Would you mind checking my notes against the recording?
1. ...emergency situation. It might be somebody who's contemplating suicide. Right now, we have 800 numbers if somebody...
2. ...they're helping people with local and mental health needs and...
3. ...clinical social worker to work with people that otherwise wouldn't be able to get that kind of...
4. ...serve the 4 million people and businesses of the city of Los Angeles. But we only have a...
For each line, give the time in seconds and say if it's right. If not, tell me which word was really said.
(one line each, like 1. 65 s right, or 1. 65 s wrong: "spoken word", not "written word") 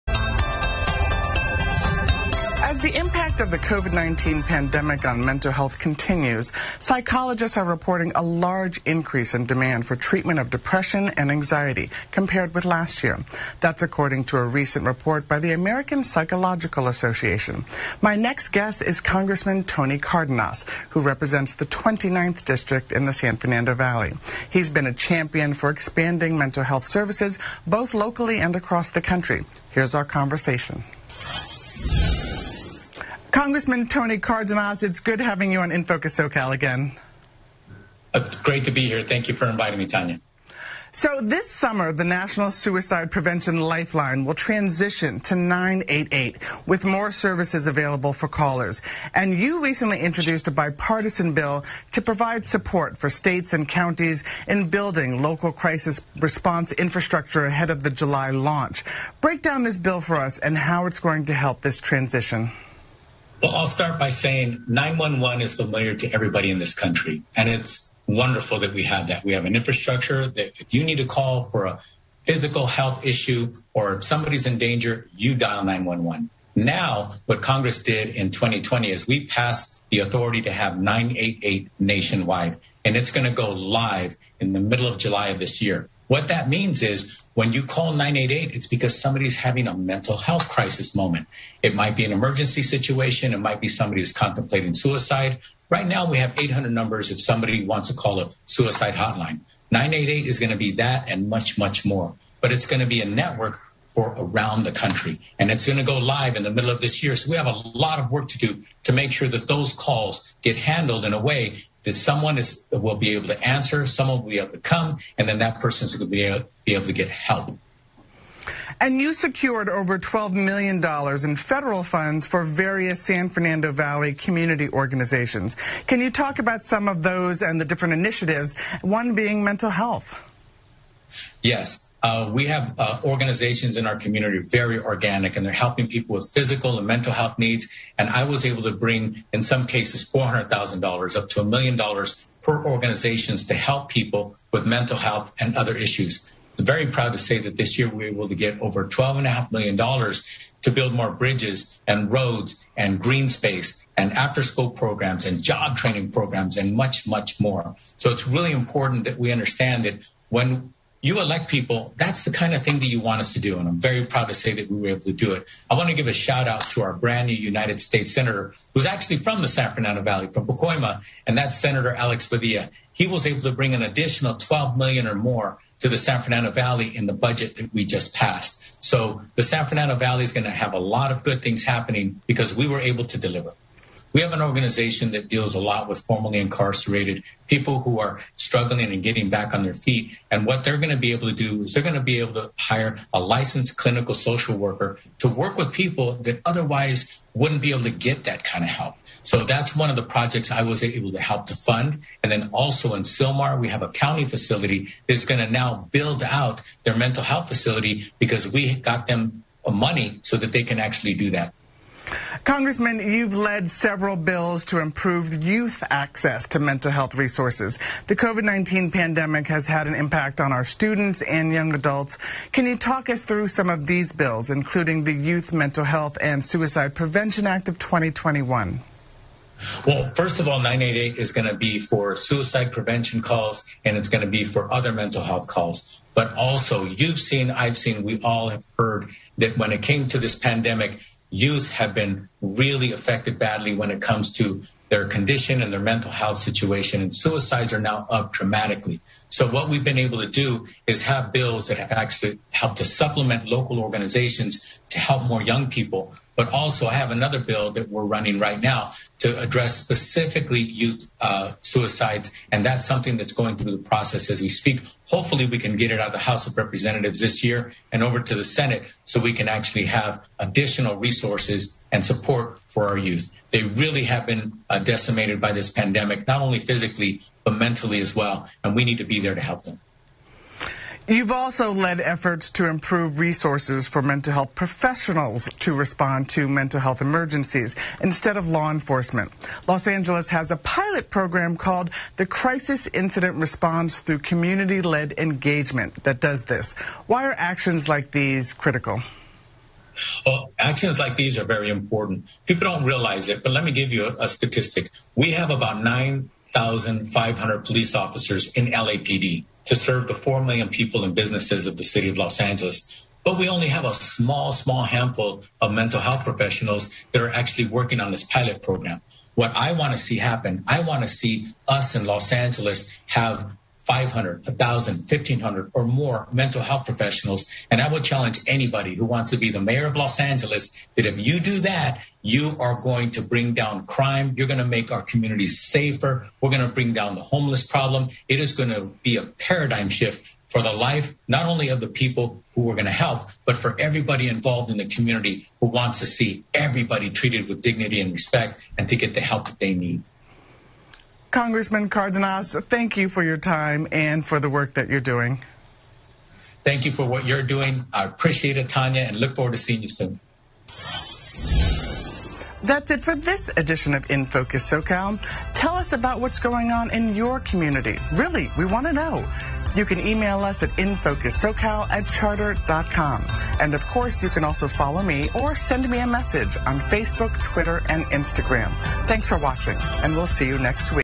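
1. 92 s right
2. 135 s wrong: "physical", not "local"
3. 193 s right
4. 309 s right.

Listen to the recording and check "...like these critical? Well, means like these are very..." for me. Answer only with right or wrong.
wrong.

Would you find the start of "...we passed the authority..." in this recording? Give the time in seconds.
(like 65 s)
79 s.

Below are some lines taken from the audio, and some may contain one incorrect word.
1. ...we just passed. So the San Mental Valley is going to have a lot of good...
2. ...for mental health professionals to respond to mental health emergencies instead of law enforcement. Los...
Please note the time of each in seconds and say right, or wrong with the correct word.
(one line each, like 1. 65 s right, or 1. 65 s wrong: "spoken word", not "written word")
1. 177 s wrong: "Fernando", not "Mental"
2. 283 s right.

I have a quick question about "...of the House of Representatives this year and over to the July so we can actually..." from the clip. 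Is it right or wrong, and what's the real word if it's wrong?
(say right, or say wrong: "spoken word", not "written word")
wrong: "Senate", not "July".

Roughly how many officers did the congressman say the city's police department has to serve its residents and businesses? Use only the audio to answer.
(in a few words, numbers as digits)
9,500.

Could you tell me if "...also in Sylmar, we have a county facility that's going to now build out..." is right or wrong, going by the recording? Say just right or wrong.
right.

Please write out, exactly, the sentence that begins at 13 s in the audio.
That's according to a recent report by the American Psychological Association.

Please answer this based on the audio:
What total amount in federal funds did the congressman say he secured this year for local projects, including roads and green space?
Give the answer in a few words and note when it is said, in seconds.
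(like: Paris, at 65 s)
$12.5 million, at 148 s.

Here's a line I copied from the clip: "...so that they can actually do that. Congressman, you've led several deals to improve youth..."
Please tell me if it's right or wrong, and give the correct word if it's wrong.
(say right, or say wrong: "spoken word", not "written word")
wrong: "bills", not "deals".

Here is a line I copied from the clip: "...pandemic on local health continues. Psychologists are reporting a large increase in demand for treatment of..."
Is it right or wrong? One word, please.
wrong.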